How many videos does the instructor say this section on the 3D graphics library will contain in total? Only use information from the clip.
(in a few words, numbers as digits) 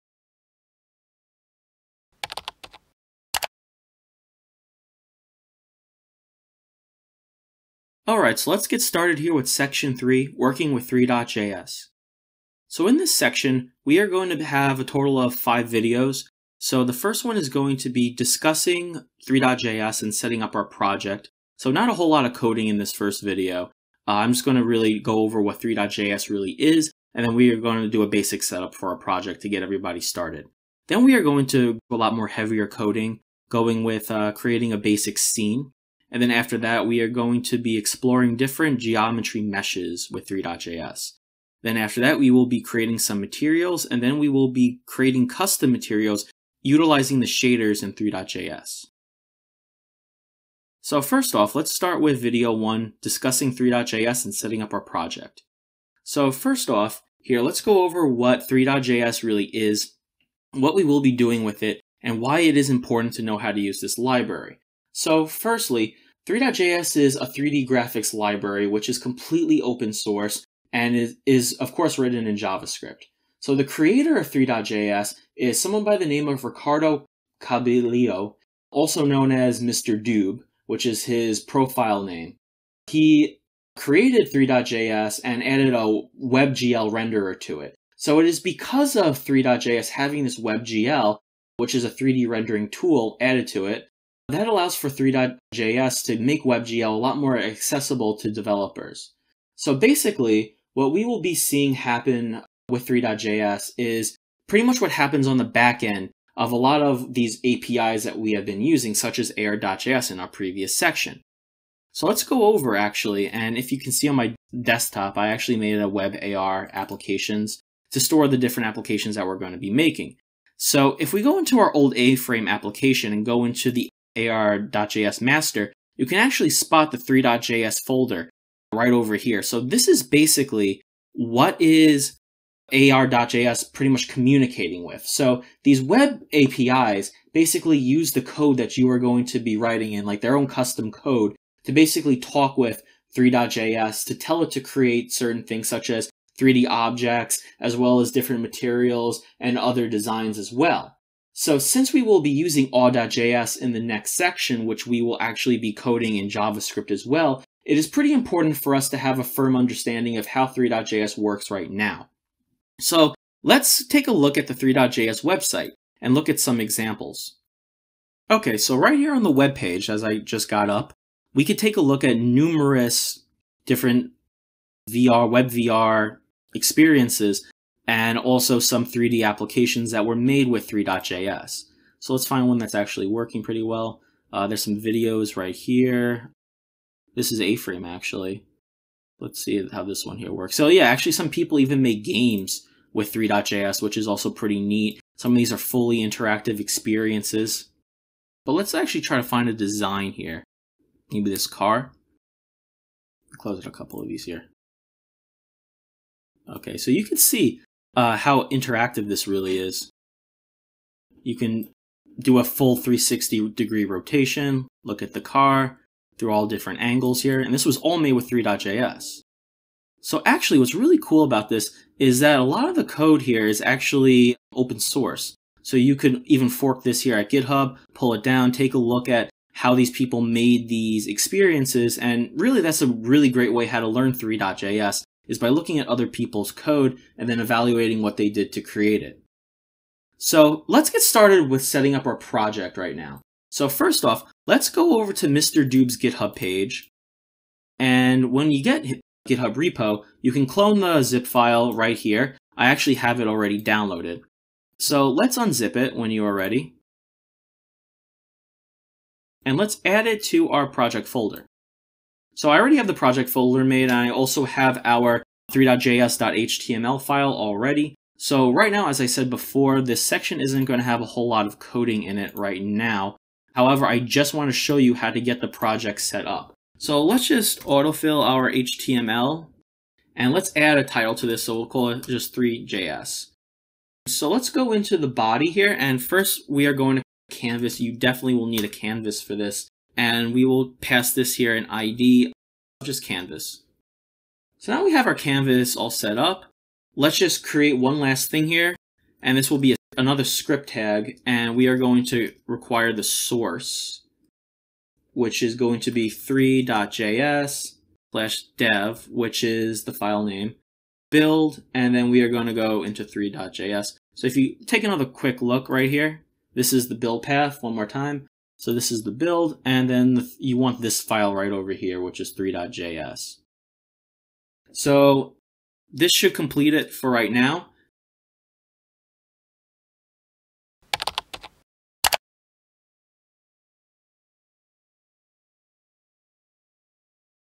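5.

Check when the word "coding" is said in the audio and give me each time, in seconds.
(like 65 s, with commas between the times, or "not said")
22 s, 32 s, 155 s, 271 s.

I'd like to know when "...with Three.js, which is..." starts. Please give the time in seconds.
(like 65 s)
192 s.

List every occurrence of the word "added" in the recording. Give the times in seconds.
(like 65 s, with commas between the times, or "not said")
85 s, 93 s.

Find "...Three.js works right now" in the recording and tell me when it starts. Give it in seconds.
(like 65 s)
160 s.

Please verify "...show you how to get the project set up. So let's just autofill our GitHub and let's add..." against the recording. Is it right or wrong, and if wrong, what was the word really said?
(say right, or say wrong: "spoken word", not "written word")
wrong: "HTML", not "GitHub".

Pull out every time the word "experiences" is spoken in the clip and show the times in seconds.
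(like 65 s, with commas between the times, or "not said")
176 s, 196 s, 231 s.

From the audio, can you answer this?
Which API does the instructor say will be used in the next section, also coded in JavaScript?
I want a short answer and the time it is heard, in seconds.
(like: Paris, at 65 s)
Awe.js, at 152 s.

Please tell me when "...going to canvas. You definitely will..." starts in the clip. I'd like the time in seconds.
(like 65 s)
286 s.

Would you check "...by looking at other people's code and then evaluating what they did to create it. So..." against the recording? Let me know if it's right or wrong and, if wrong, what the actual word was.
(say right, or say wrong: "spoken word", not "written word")
right.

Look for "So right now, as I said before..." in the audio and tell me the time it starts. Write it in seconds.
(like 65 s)
268 s.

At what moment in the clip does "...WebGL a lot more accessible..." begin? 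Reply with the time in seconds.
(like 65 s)
96 s.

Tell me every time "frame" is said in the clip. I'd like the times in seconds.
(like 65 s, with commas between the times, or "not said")
121 s, 187 s.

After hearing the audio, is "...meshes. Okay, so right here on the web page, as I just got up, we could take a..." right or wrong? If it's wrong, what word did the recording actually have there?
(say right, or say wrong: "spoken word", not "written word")
wrong: "examples", not "meshes".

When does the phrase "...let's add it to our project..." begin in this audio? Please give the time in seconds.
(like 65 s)
259 s.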